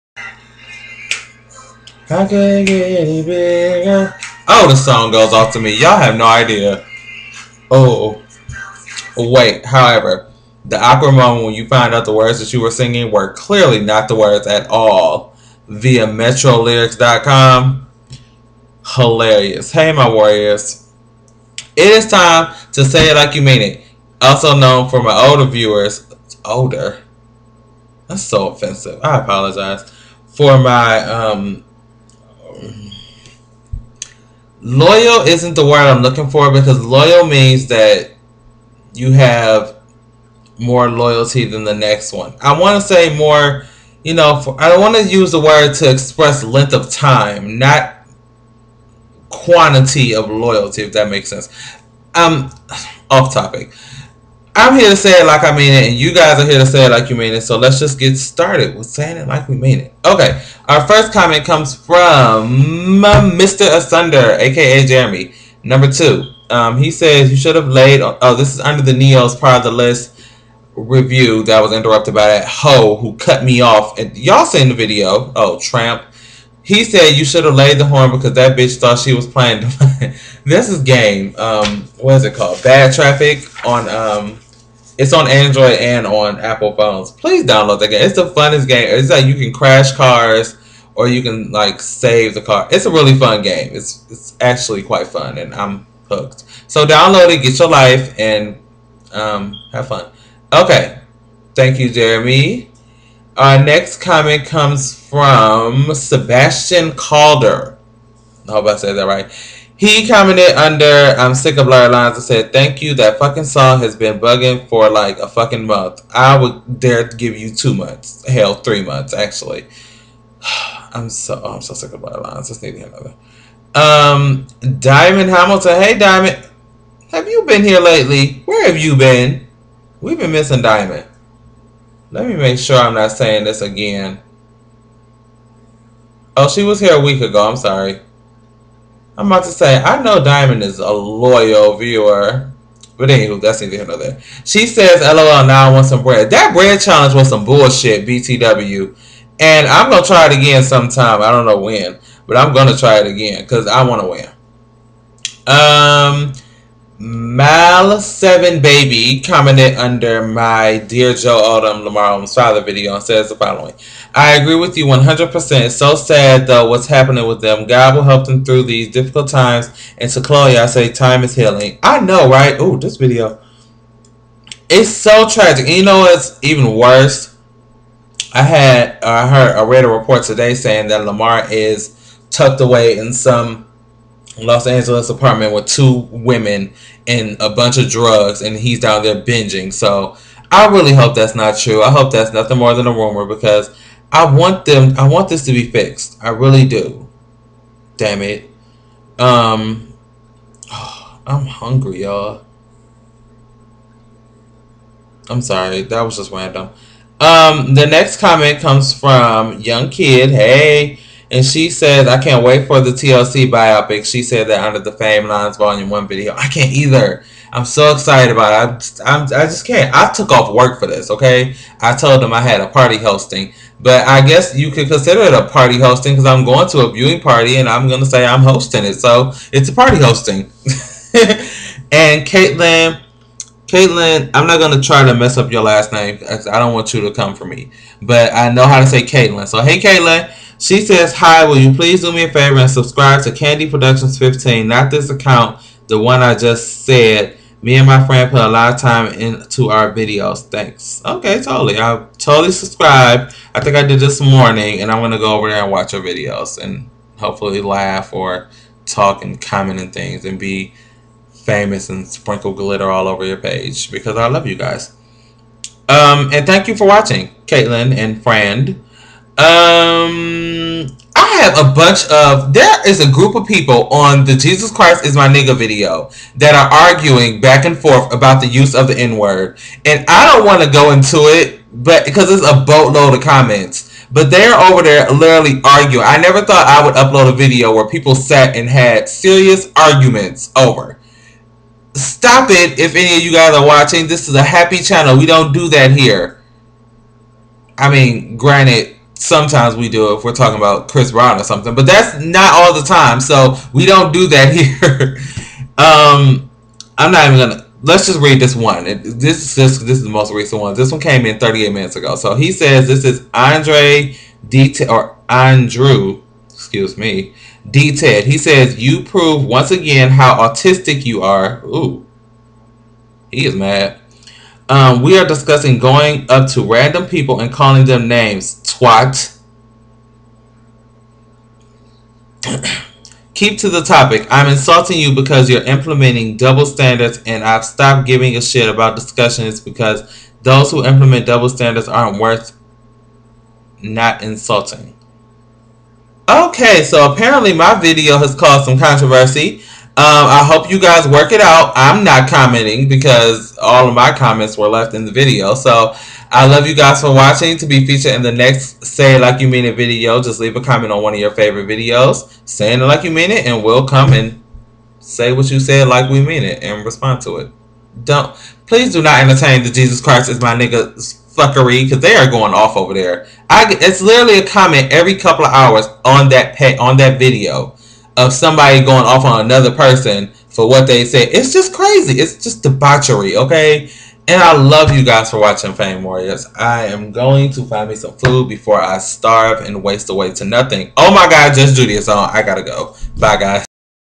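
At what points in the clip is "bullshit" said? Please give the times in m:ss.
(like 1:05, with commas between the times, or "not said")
2:27.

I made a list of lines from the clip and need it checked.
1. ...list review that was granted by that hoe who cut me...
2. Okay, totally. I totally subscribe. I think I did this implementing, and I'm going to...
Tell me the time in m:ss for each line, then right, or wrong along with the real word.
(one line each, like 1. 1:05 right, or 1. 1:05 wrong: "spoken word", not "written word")
1. 1:09 wrong: "interrupted", not "granted"
2. 4:11 wrong: "morning", not "implementing".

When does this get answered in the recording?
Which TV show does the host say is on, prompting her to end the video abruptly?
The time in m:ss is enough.
6:31.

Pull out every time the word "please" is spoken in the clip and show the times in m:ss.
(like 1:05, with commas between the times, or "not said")
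1:27, 4:01, 6:08.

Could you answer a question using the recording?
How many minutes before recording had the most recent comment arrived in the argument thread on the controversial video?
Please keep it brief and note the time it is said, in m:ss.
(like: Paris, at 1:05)
38, at 5:11.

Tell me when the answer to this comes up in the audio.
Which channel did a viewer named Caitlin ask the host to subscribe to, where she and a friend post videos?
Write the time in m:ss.
4:03.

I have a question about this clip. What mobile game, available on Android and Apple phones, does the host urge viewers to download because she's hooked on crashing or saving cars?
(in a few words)
Bad Traffic.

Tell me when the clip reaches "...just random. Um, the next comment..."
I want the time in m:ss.
3:26.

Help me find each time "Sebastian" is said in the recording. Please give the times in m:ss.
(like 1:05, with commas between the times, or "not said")
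1:45.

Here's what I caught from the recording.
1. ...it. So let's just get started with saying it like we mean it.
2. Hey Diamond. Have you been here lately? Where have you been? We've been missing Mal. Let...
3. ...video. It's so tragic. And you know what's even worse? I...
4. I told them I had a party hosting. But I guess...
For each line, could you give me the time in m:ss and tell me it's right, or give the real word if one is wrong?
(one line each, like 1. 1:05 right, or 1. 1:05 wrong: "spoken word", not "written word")
1. 0:57 right
2. 2:05 wrong: "Diamond", not "Mal"
3. 2:52 right
4. 3:41 right.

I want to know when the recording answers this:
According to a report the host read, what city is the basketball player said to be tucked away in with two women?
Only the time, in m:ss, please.
3:04.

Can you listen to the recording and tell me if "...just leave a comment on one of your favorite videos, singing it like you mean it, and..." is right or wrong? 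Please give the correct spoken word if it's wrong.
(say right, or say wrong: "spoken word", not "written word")
wrong: "saying", not "singing".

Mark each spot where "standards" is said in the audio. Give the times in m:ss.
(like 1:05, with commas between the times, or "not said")
5:36, 5:41.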